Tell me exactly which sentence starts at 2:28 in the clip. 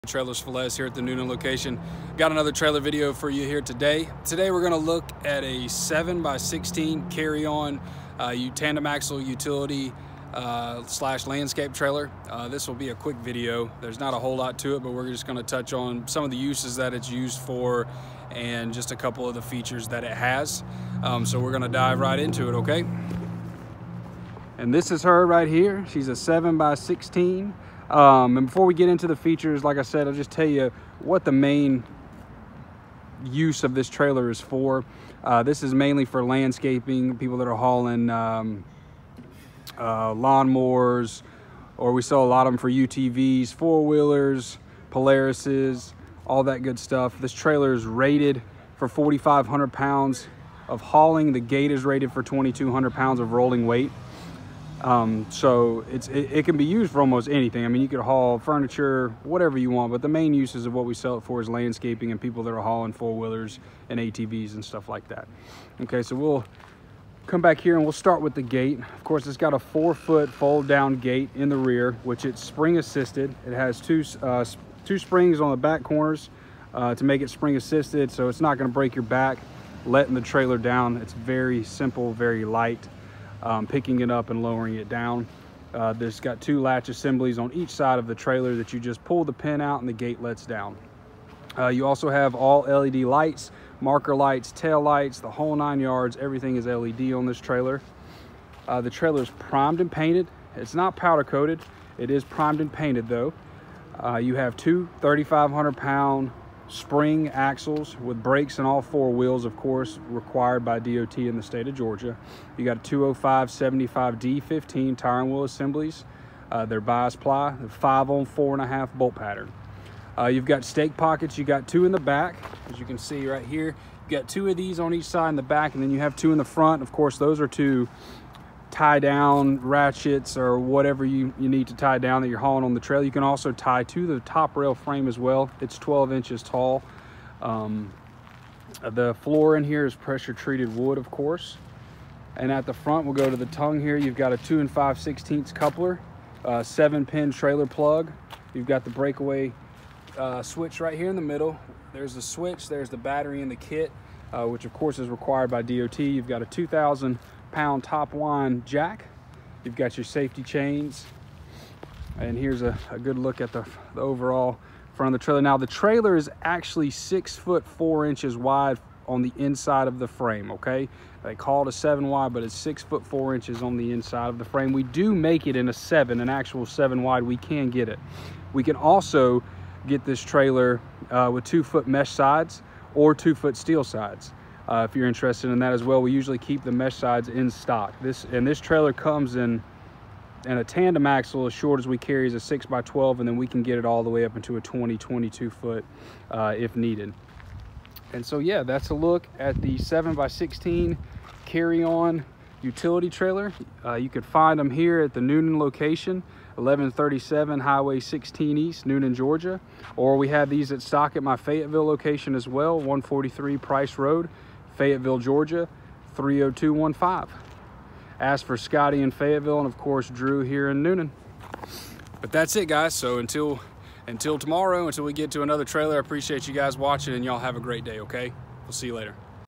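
You've got the breakaway uh, switch right here in the middle.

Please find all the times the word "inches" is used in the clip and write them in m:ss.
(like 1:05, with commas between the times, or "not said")
2:16, 2:48, 2:53.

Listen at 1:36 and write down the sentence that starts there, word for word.
Everything is LED on this trailer.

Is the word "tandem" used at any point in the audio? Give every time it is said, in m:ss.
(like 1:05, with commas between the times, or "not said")
0:08, 3:10.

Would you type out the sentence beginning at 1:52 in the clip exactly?
You got 205 75D15 tire and wheel assemblies.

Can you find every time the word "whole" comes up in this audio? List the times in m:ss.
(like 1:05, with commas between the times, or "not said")
0:14, 1:35.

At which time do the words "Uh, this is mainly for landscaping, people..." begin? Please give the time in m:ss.
0:35.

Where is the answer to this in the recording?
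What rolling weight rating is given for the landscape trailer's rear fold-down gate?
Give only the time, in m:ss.
0:52.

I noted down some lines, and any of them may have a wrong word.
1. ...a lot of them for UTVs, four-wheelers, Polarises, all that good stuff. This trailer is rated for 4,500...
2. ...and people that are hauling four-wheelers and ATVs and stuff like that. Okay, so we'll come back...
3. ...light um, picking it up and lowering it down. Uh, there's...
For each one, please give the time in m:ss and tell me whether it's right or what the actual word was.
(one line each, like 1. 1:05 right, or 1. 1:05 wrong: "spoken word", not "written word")
1. 0:42 right
2. 1:02 right
3. 1:22 right.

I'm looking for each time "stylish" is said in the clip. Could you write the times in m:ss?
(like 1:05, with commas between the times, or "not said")
not said.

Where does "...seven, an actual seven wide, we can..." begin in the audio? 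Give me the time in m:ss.
2:55.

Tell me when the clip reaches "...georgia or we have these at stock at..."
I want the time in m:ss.
3:29.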